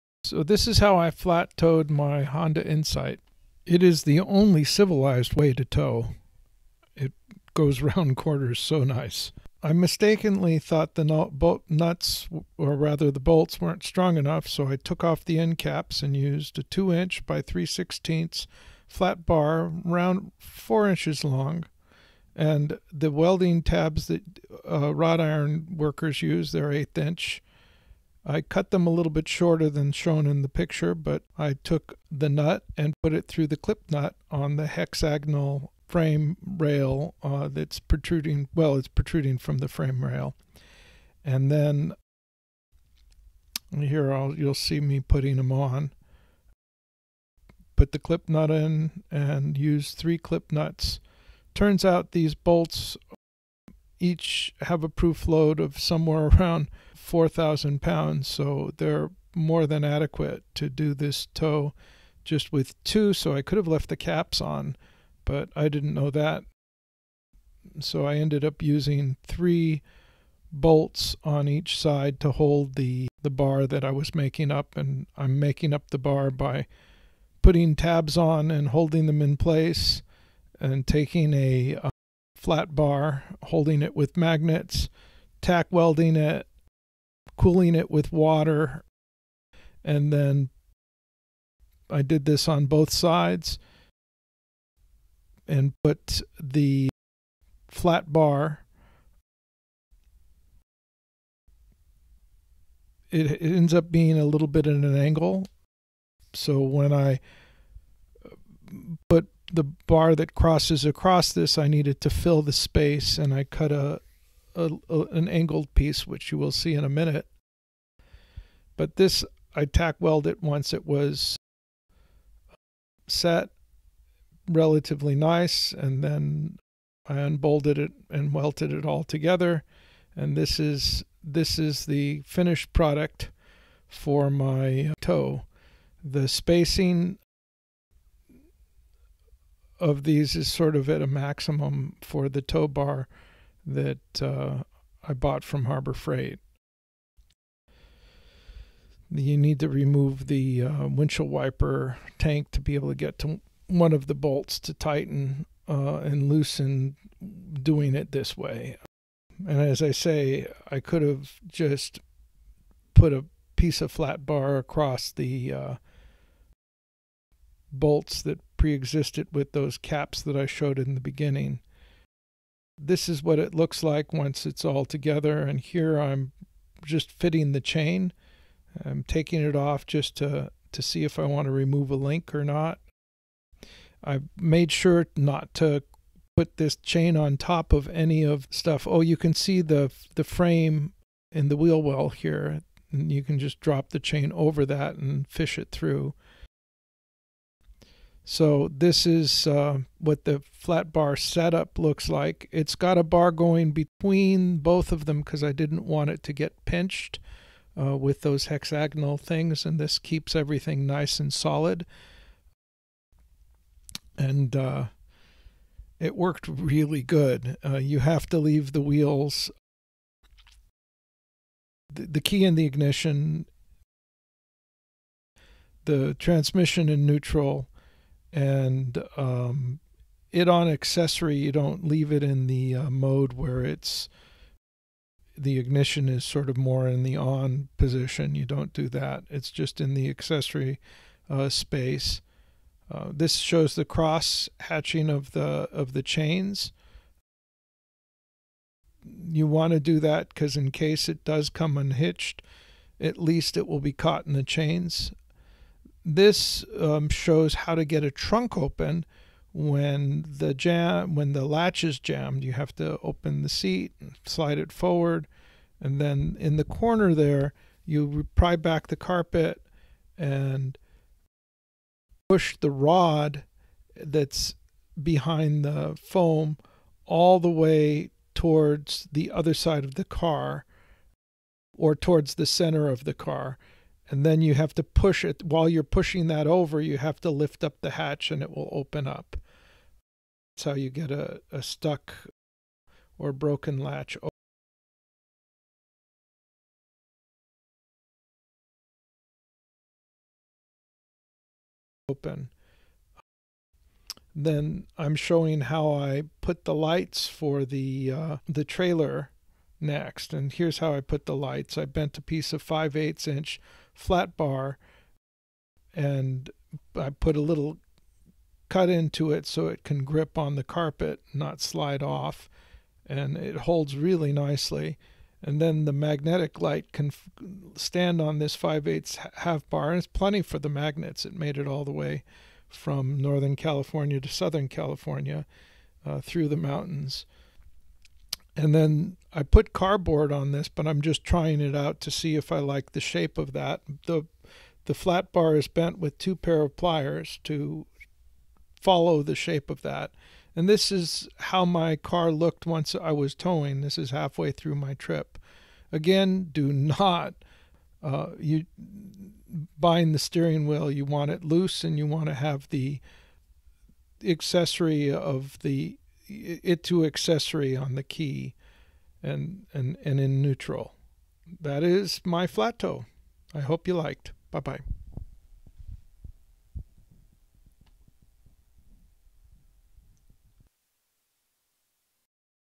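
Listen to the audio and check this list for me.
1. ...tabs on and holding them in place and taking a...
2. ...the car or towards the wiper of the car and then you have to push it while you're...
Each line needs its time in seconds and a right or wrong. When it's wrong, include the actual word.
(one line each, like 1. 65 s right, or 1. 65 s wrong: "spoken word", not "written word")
1. 77 s right
2. 279 s wrong: "center", not "wiper".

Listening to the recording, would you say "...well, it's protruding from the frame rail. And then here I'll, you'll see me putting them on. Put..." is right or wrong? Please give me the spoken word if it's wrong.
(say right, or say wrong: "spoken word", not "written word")
right.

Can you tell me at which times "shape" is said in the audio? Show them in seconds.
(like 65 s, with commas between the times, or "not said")
342 s, 349 s.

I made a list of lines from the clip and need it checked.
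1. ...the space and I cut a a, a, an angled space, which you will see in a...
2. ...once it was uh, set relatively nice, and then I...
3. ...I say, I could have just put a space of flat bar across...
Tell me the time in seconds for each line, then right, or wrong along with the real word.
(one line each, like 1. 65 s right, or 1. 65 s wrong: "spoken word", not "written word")
1. 112 s wrong: "piece", not "space"
2. 120 s right
3. 159 s wrong: "piece", not "space".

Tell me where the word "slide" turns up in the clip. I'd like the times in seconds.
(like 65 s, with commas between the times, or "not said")
264 s, 321 s.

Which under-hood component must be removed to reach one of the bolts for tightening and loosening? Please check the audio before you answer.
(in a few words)
windshield wiper tank.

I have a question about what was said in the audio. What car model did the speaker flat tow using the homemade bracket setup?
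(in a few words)
Honda Insight.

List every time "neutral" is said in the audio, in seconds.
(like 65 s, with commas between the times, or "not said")
227 s, 370 s.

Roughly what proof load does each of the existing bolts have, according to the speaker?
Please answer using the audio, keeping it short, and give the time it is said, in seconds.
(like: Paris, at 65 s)
4,000 pounds, at 57 s.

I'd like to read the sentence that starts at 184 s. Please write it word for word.
I've made sure not to put this chain on top of any of stuff.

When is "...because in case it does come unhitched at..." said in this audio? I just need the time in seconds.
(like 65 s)
250 s.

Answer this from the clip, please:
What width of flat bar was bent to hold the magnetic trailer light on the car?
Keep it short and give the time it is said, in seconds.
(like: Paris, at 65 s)
5/8 inch, at 312 s.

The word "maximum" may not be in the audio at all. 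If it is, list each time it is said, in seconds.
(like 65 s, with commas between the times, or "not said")
141 s.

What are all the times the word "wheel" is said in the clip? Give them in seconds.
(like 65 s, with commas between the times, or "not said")
191 s, 218 s, 360 s.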